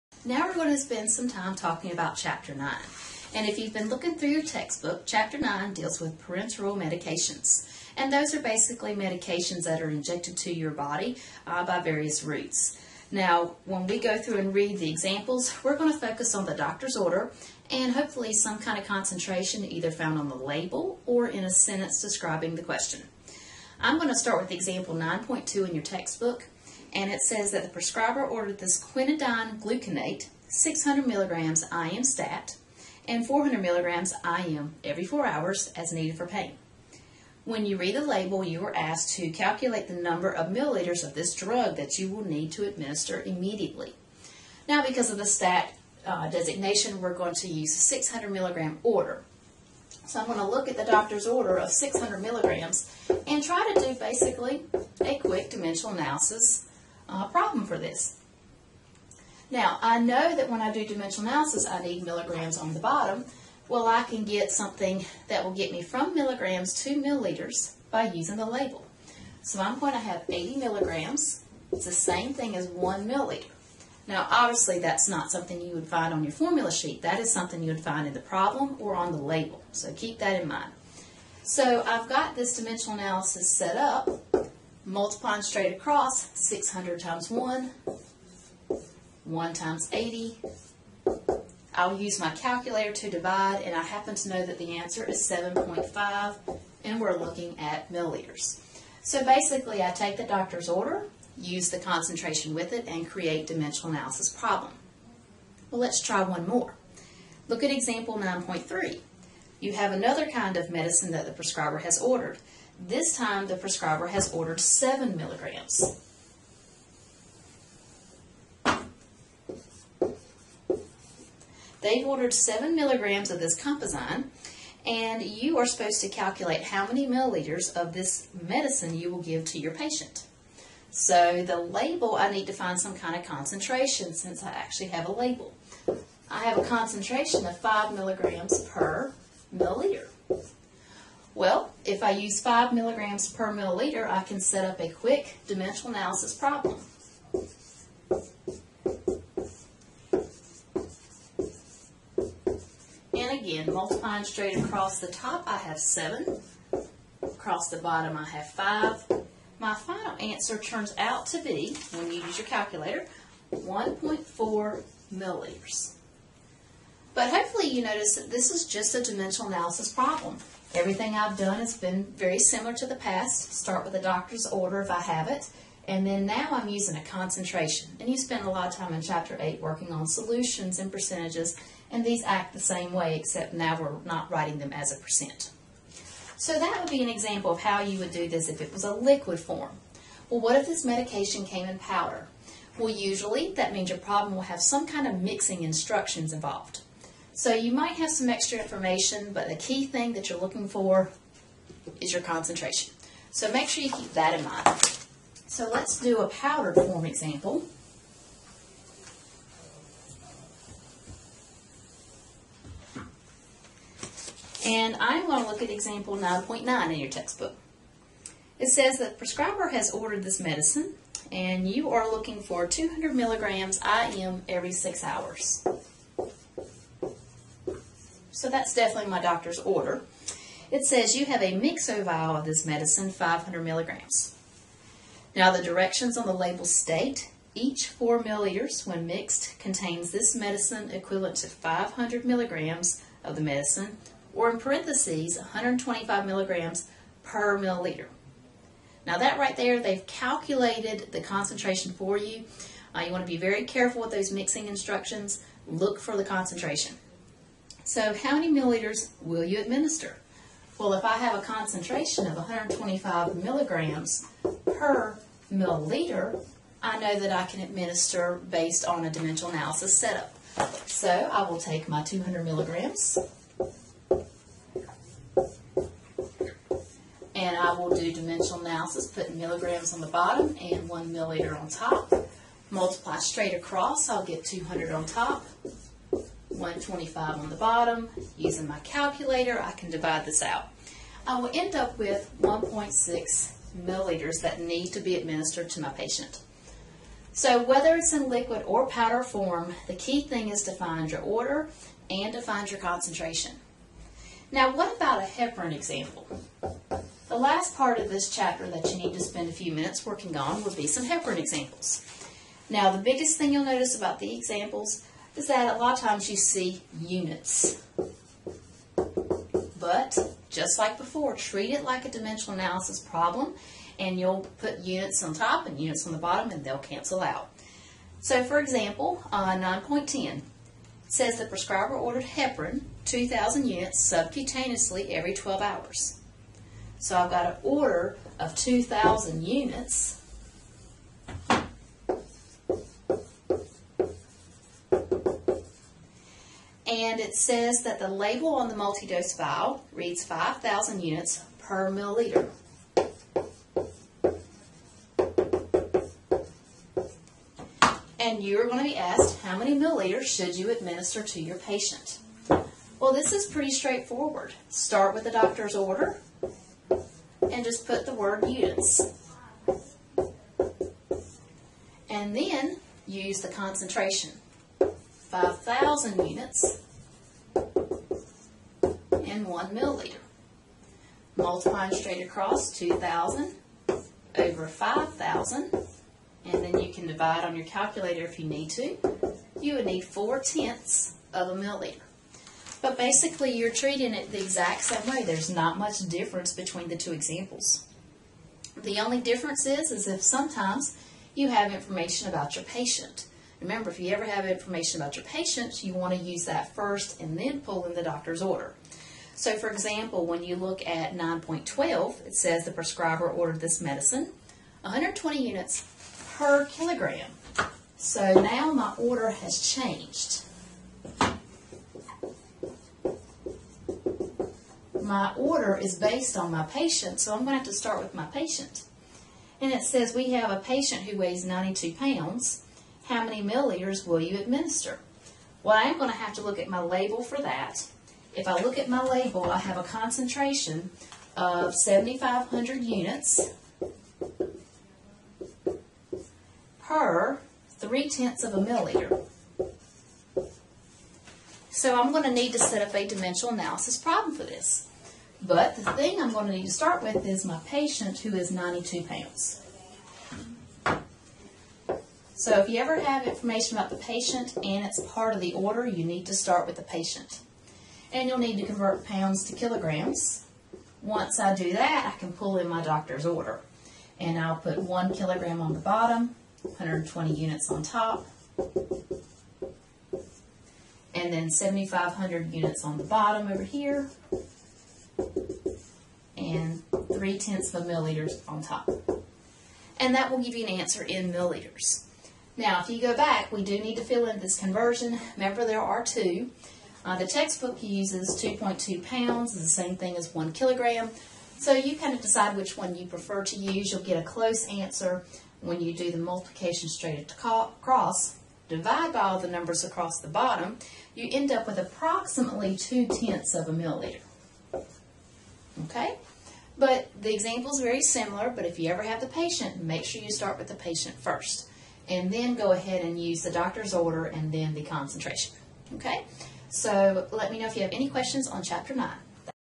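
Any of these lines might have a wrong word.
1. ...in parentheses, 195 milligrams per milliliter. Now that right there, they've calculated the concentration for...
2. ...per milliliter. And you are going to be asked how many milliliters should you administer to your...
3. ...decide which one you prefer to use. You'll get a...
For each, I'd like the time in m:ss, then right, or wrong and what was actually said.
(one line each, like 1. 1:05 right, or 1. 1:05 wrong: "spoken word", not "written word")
1. 4:04 wrong: "125", not "195"
2. 5:51 right
3. 8:22 right.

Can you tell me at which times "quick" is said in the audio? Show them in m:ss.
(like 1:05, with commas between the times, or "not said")
0:55, 2:24.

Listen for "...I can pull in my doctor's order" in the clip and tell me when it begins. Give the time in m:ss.
7:52.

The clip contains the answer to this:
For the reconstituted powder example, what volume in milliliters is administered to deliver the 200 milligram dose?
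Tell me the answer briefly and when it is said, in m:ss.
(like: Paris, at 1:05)
1.6 milliliters, at 4:52.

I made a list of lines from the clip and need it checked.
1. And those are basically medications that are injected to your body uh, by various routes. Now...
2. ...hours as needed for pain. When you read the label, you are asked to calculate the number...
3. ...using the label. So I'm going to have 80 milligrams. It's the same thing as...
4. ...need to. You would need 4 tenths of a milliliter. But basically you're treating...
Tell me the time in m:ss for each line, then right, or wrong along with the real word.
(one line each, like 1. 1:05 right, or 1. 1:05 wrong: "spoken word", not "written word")
1. 0:07 right
2. 0:35 right
3. 1:08 right
4. 6:28 right.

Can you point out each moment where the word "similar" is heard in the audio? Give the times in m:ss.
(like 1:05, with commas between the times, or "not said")
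2:52, 8:38.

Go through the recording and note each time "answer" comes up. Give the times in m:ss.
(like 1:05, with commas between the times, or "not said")
1:34, 2:40, 8:10, 8:24.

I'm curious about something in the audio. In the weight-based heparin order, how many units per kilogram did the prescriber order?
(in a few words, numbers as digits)
120 units.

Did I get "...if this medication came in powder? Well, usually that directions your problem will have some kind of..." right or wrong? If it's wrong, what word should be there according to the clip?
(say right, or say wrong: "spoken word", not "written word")
wrong: "means", not "directions".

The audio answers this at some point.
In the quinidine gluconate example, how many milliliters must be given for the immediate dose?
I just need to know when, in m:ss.
1:35.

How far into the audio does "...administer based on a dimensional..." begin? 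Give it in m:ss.
4:27.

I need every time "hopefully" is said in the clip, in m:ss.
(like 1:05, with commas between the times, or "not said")
0:17, 2:47.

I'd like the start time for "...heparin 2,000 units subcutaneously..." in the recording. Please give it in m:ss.
5:32.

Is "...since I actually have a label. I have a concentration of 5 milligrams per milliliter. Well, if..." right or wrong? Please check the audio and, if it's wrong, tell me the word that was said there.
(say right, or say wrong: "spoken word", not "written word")
right.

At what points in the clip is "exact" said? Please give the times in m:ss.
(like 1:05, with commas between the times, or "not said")
6:34.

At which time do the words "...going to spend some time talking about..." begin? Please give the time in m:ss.
0:00.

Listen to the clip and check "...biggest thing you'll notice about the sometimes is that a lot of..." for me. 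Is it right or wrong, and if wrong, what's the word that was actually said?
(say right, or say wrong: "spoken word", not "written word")
wrong: "examples", not "sometimes".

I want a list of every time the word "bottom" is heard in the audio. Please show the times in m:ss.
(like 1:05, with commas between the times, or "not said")
1:02, 2:37, 4:40, 4:47, 5:26, 7:55, 8:03, 8:30.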